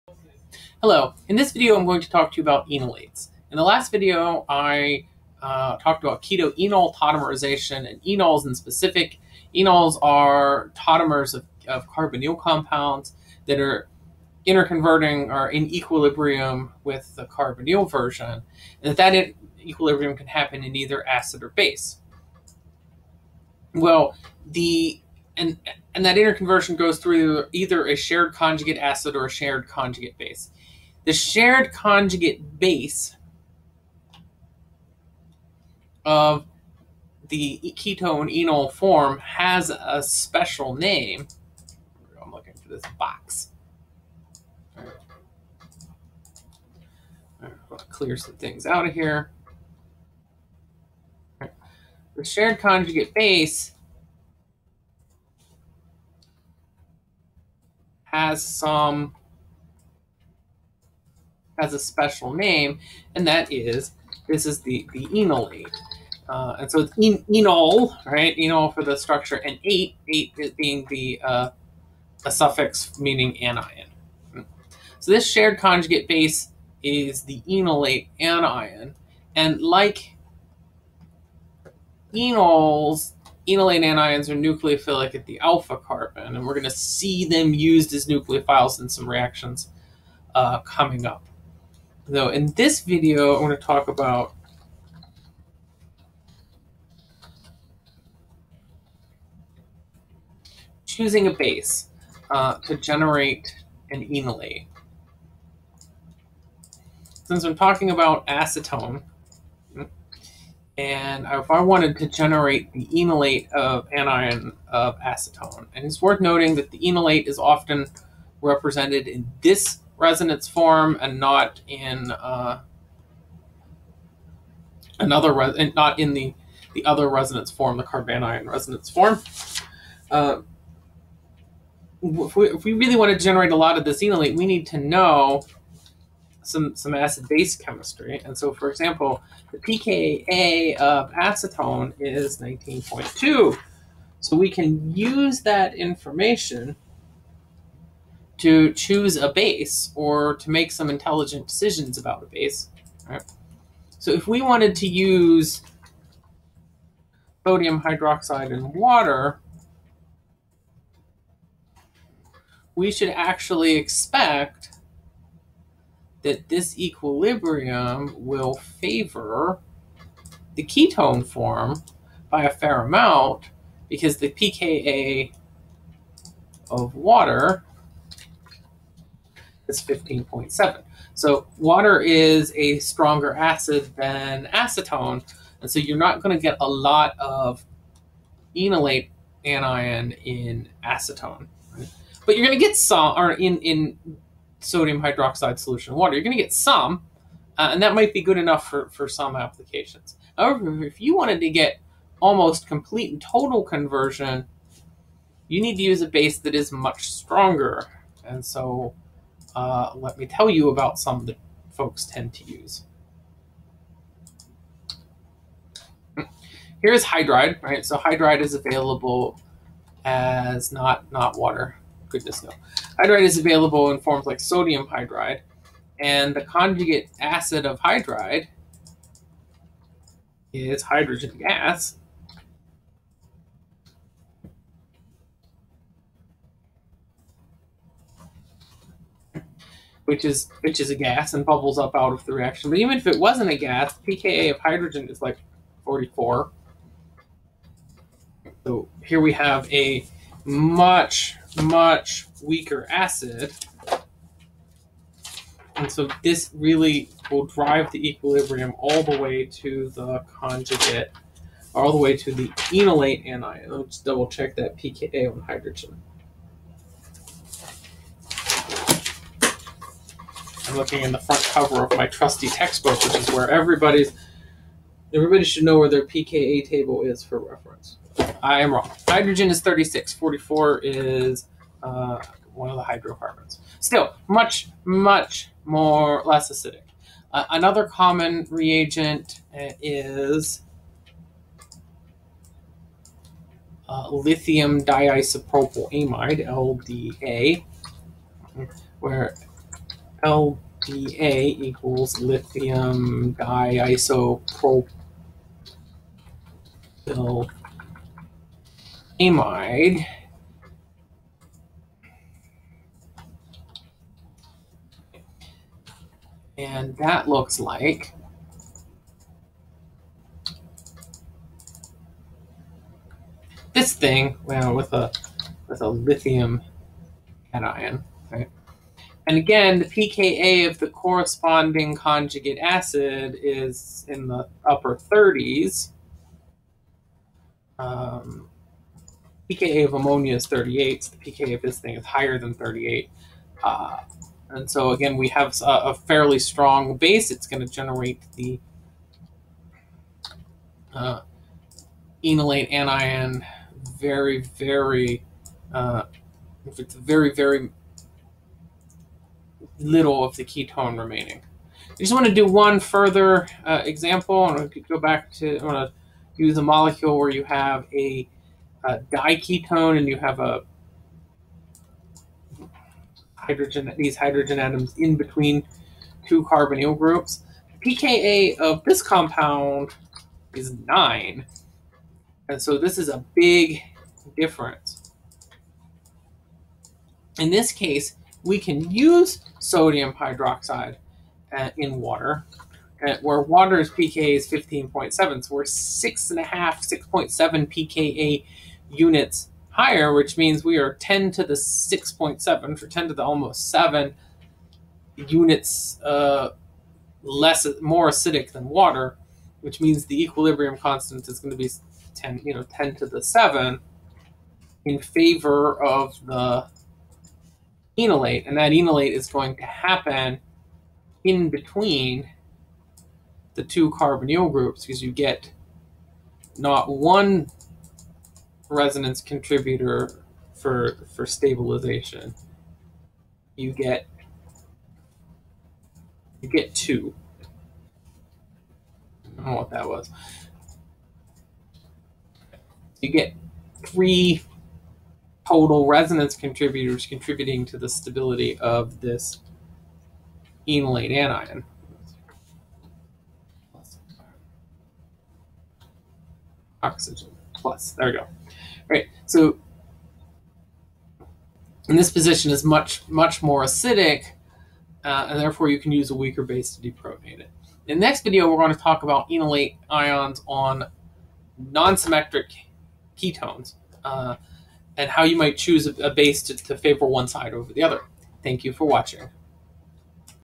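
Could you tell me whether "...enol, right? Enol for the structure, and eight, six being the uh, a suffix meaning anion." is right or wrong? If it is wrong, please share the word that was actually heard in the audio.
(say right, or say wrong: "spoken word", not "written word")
wrong: "eight", not "six".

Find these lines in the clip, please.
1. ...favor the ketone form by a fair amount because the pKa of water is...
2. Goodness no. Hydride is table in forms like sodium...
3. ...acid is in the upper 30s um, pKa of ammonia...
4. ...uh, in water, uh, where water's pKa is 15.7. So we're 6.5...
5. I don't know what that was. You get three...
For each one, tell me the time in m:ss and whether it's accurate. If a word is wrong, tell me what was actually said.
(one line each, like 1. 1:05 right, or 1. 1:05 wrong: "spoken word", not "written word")
1. 2:48 right
2. 3:42 wrong: "available", not "table"
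3. 5:32 right
4. 6:31 right
5. 7:19 right.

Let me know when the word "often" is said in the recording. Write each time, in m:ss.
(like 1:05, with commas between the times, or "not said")
1:57.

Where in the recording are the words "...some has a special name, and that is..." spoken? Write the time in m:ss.
0:58.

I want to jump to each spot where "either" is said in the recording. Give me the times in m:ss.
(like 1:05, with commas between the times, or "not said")
0:20, 0:27.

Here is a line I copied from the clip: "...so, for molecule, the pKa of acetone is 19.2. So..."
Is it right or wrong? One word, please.
wrong.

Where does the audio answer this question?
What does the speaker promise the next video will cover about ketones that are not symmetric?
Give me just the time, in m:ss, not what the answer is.
7:49.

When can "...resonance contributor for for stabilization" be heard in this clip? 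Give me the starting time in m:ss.
7:08.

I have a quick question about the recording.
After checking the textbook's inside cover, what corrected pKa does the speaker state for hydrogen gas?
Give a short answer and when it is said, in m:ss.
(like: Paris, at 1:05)
36, at 4:39.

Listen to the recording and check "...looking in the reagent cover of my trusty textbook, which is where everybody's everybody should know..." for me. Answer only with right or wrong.
wrong.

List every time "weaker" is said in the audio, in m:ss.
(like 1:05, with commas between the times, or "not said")
4:12, 7:46.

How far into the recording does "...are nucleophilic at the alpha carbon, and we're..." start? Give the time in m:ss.
1:24.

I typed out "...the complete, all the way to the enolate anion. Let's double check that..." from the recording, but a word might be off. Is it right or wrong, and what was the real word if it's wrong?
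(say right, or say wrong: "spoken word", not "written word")
wrong: "conjugate", not "complete".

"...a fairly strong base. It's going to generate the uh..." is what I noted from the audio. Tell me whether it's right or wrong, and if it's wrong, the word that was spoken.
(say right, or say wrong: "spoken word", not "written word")
right.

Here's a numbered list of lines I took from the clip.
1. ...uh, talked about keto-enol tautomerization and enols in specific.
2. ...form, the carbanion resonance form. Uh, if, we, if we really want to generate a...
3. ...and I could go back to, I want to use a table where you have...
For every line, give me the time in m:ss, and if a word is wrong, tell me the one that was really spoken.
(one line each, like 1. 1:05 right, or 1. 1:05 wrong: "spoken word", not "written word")
1. 0:05 right
2. 2:07 right
3. 6:04 wrong: "molecule", not "table".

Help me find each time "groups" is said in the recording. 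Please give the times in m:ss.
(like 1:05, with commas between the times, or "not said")
6:16, 7:04.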